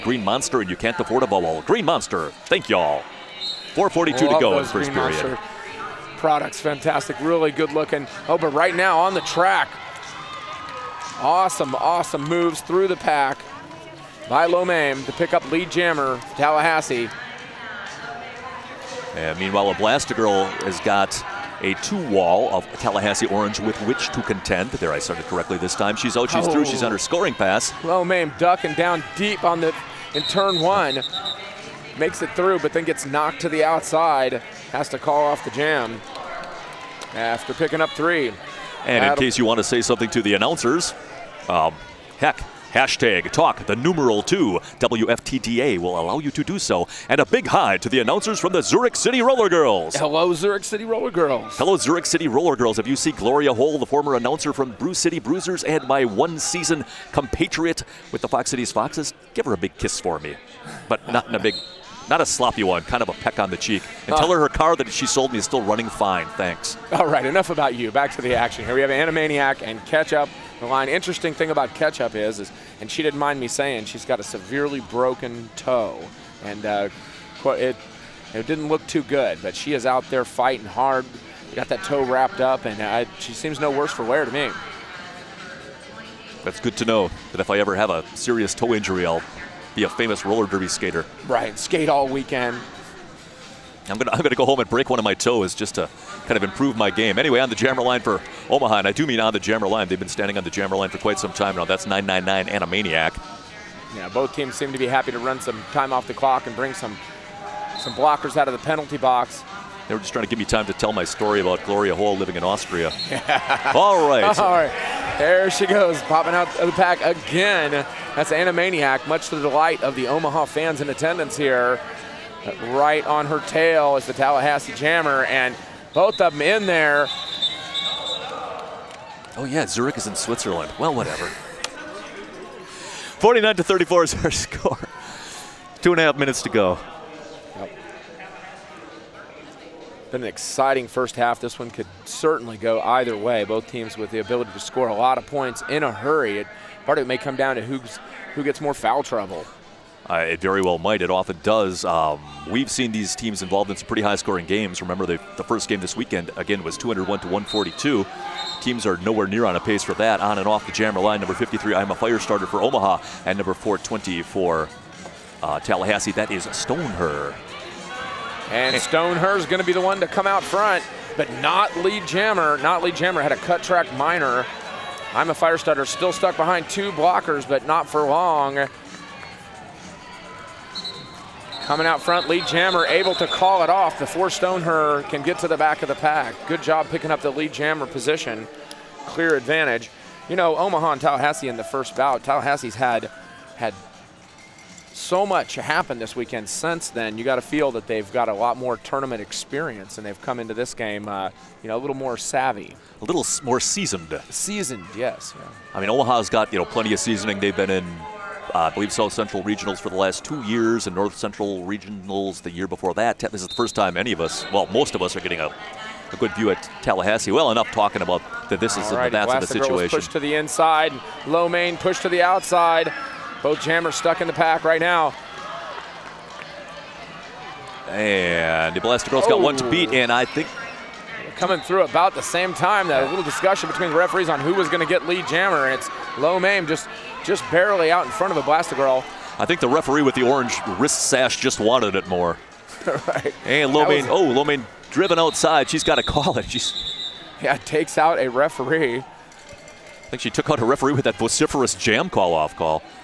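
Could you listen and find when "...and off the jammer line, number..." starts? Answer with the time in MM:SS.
02:40.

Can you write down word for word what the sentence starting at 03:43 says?
Both jammers stuck in the pack right now.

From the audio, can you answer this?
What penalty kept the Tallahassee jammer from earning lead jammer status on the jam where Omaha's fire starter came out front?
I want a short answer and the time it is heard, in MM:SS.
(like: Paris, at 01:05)
Cut track minor, at 02:53.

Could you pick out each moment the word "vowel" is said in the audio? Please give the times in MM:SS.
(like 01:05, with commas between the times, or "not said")
00:01.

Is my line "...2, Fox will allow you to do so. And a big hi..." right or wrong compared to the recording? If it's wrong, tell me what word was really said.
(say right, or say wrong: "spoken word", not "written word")
wrong: "WFTDA", not "Fox".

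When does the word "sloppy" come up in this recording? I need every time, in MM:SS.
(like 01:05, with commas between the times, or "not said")
01:02.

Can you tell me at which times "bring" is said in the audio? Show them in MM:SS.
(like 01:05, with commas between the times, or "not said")
01:46.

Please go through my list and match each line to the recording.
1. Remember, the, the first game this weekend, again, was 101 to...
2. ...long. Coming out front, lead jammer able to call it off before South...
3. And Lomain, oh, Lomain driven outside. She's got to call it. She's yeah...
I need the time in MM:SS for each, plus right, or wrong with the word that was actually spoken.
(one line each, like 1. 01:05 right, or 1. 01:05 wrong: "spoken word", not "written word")
1. 02:34 wrong: "201", not "101"
2. 02:58 wrong: "Stoneher", not "South"
3. 04:03 right.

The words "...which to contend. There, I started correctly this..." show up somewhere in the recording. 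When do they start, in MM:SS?
00:23.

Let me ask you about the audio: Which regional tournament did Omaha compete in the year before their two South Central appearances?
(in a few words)
North Central Regionals.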